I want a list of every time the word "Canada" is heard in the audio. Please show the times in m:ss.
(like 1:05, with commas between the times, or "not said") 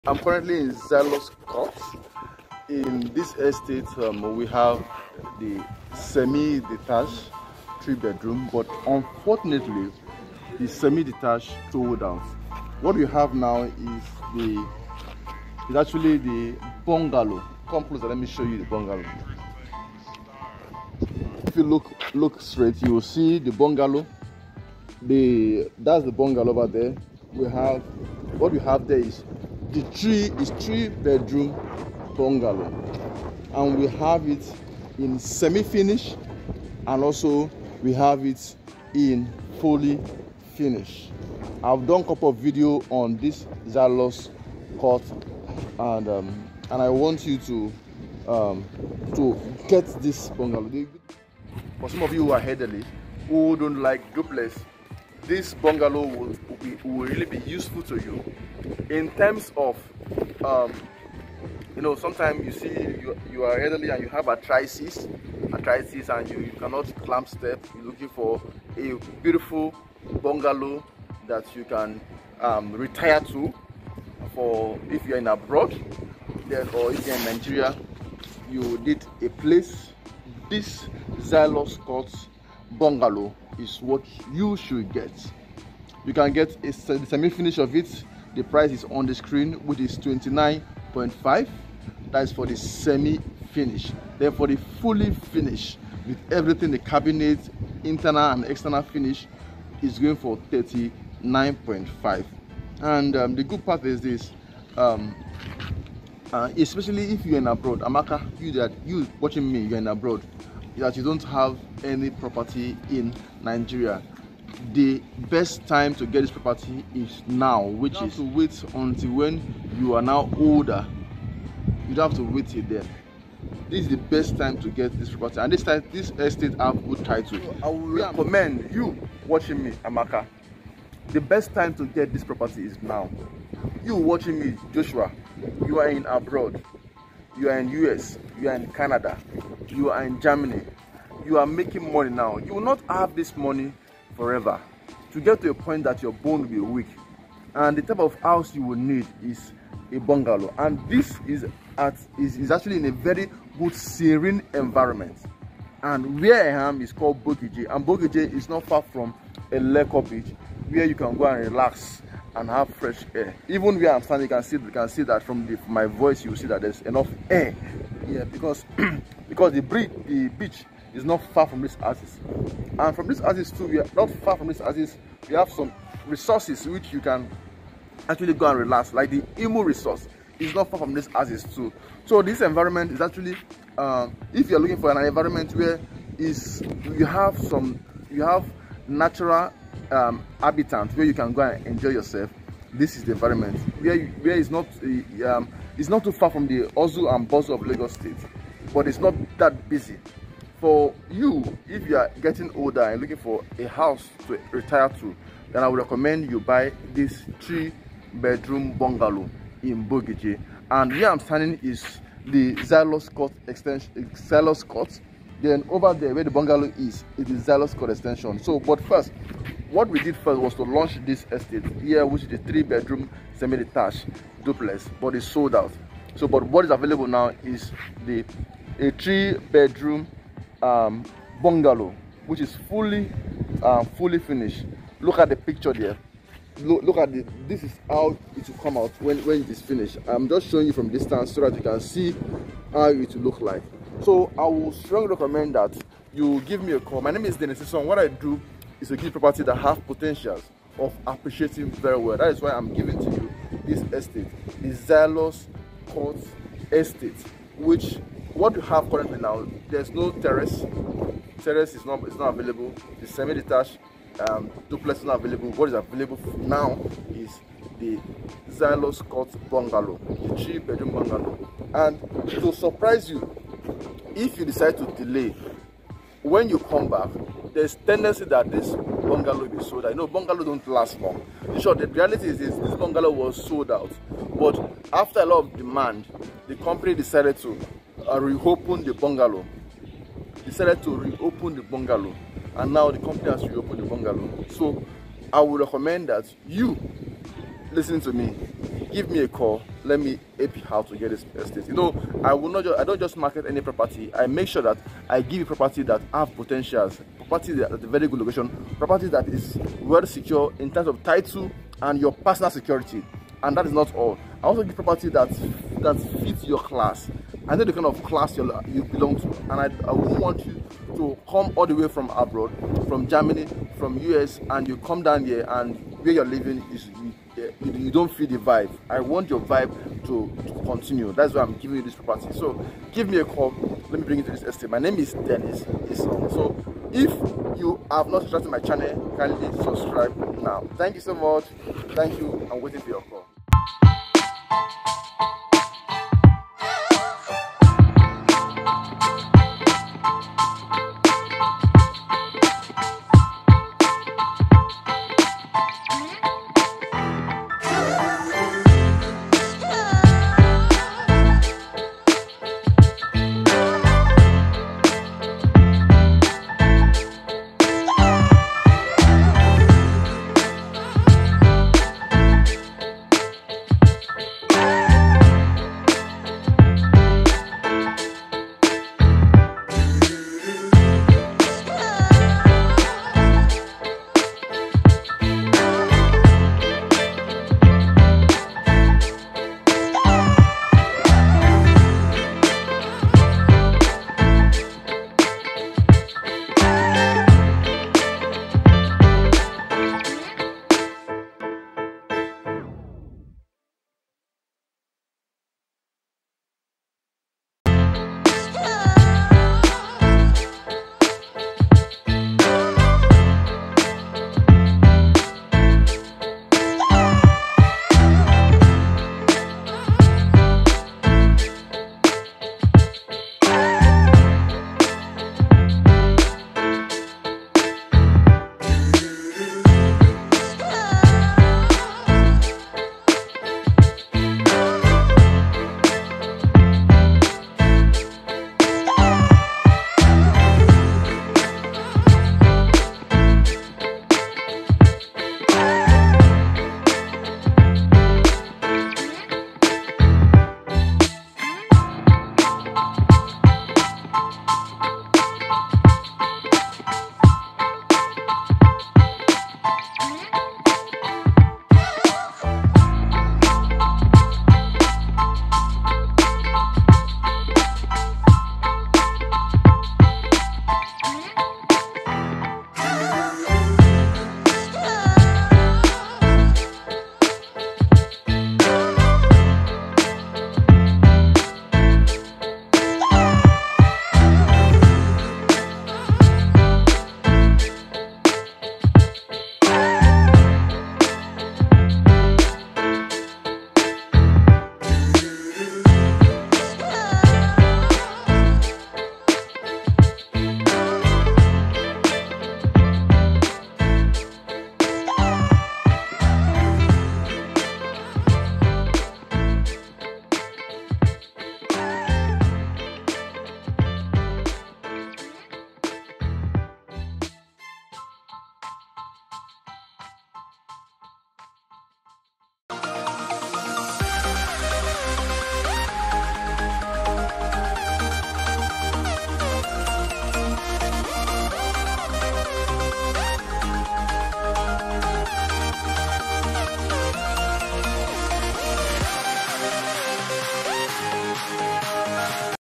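2:18.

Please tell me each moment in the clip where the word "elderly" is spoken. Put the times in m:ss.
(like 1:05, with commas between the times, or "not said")
0:52, 1:03.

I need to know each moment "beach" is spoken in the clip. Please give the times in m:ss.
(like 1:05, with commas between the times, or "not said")
2:40, 2:50.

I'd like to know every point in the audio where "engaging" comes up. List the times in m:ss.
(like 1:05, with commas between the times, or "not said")
not said.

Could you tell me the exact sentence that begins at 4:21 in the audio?
Terrace is not, is not available.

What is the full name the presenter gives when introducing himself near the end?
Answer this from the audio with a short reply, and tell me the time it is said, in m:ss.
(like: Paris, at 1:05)
Dennis Isong, at 5:35.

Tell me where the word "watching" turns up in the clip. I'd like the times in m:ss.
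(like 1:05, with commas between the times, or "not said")
1:49, 2:09, 2:13.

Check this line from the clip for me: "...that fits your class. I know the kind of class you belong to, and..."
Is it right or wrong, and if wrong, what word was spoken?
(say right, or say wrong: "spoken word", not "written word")
right.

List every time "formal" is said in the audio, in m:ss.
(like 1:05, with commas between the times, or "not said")
not said.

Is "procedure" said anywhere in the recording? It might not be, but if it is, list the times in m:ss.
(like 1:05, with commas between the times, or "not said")
not said.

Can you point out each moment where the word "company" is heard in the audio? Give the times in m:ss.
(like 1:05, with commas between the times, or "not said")
4:46, 4:52.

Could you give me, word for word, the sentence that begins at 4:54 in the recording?
So I would recommend that you listen to me.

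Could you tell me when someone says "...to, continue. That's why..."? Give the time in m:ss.
5:30.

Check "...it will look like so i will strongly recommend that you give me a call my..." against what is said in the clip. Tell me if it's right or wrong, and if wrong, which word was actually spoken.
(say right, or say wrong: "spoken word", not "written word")
right.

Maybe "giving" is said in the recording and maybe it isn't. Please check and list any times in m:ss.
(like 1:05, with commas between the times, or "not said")
4:12, 5:31.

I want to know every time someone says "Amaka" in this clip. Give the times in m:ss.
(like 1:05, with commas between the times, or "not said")
1:47, 2:09.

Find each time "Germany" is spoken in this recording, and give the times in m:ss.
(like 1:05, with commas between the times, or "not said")
2:20, 5:23.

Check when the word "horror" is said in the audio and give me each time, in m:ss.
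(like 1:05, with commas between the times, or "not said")
not said.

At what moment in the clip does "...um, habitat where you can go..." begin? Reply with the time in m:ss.
3:09.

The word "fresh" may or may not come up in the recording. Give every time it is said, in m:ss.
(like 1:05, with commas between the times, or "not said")
2:42.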